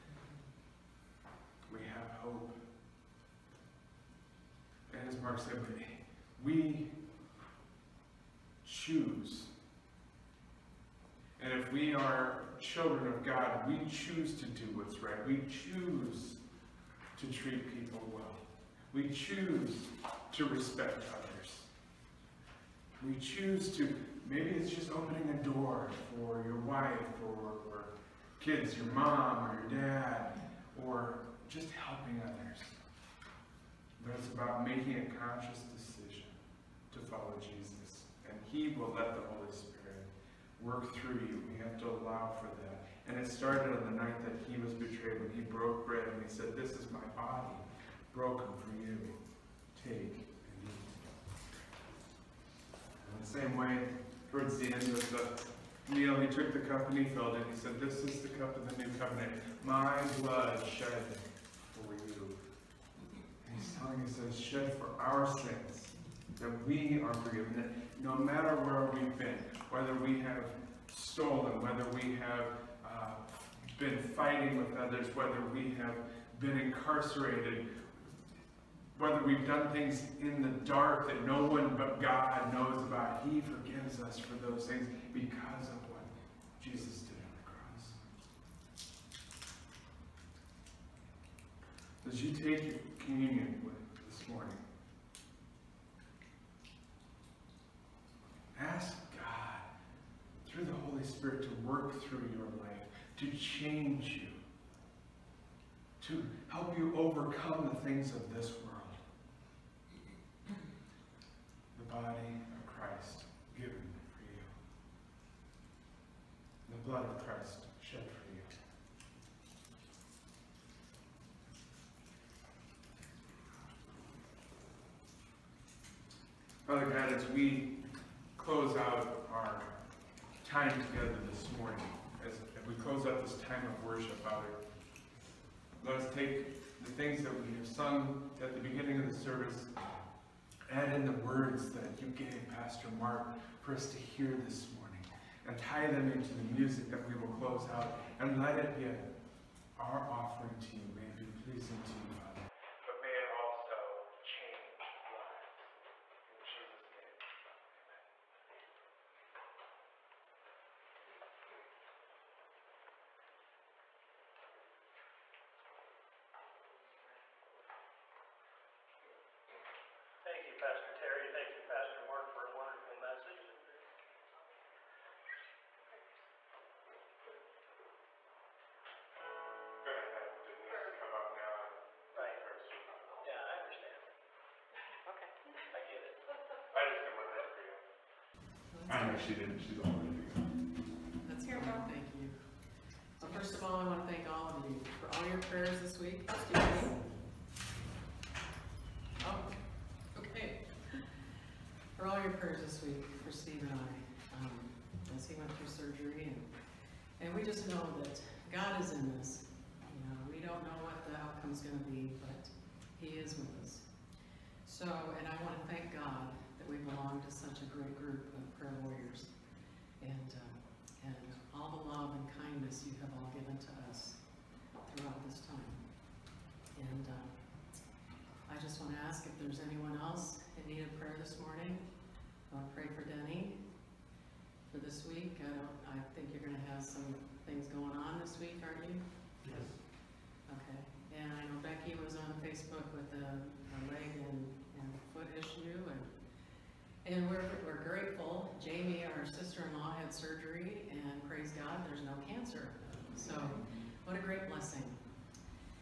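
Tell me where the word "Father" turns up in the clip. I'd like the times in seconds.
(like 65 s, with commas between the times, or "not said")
126 s, 134 s, 152 s.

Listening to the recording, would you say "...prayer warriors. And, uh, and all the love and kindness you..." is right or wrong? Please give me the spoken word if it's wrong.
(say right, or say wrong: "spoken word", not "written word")
right.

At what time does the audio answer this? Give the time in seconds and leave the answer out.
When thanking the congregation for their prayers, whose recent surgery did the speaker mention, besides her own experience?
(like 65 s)
203 s.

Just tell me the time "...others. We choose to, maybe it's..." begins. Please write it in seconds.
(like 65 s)
21 s.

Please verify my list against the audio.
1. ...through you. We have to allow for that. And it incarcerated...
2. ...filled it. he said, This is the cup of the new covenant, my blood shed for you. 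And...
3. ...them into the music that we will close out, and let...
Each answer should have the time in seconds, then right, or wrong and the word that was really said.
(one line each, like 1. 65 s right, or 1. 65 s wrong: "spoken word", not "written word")
1. 40 s wrong: "started", not "incarcerated"
2. 57 s right
3. 145 s right.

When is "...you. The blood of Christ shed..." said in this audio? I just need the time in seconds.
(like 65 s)
114 s.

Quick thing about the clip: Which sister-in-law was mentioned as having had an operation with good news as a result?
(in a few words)
Jamie.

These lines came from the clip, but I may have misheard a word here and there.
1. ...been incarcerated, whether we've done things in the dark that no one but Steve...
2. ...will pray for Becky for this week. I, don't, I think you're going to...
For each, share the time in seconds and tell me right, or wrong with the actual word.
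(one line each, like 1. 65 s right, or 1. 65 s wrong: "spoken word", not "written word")
1. 76 s wrong: "God", not "Steve"
2. 232 s wrong: "Denny", not "Becky".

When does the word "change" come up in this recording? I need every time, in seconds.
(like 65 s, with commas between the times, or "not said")
103 s, 154 s.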